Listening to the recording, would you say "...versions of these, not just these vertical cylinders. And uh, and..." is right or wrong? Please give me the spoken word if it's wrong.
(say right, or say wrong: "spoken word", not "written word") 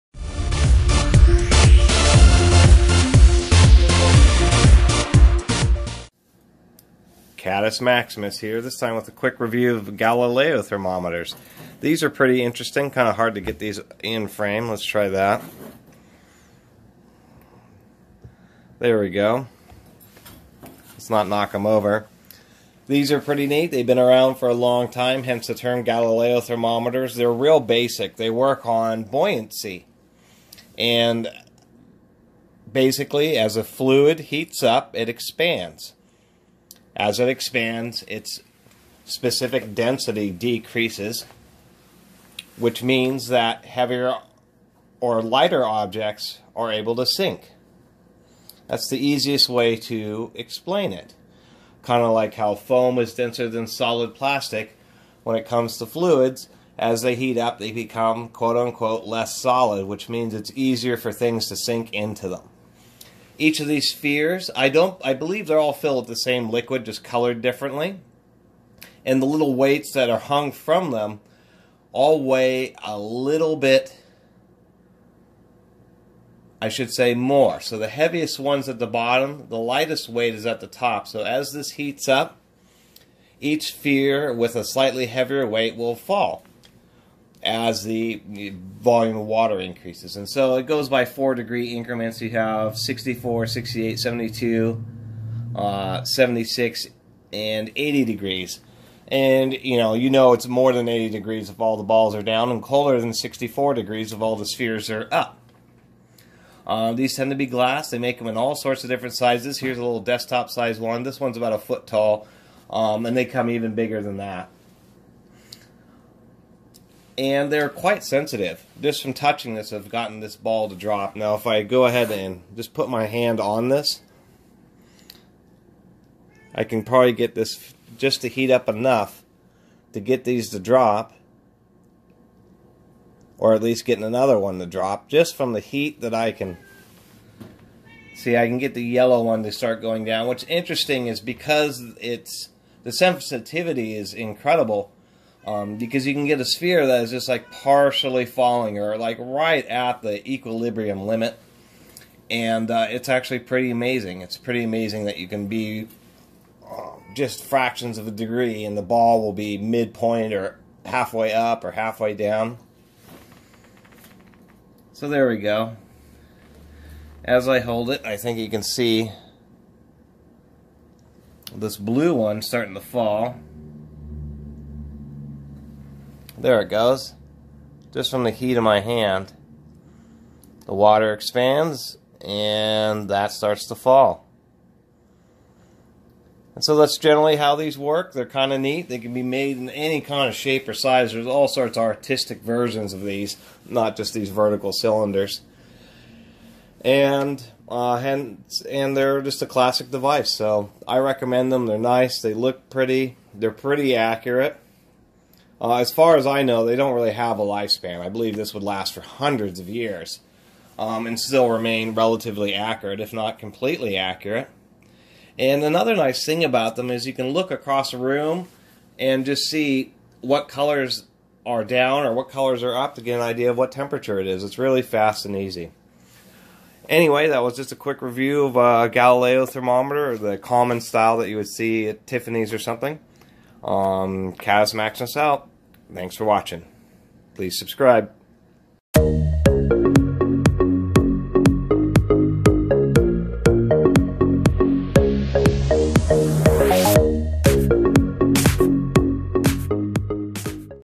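right.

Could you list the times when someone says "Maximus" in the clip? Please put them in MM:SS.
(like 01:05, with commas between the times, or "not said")
00:07, 03:54.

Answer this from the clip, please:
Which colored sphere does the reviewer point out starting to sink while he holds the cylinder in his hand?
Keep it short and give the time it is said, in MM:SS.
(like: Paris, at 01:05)
blue, at 02:51.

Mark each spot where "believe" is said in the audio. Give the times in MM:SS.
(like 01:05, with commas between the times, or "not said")
01:05, 03:28.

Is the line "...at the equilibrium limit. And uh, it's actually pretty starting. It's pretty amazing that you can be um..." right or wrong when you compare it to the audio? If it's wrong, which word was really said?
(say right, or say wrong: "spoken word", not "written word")
wrong: "amazing", not "starting".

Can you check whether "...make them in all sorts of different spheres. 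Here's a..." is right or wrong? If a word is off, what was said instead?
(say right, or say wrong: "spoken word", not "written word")
wrong: "sizes", not "spheres".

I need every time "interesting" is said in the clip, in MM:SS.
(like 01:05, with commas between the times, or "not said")
00:12, 02:20.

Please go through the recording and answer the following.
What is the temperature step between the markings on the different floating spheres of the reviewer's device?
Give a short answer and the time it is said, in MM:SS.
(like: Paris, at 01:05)
4 degrees, at 01:31.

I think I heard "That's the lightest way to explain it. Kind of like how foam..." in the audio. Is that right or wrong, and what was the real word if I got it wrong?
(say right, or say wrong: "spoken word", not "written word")
wrong: "easiest", not "lightest".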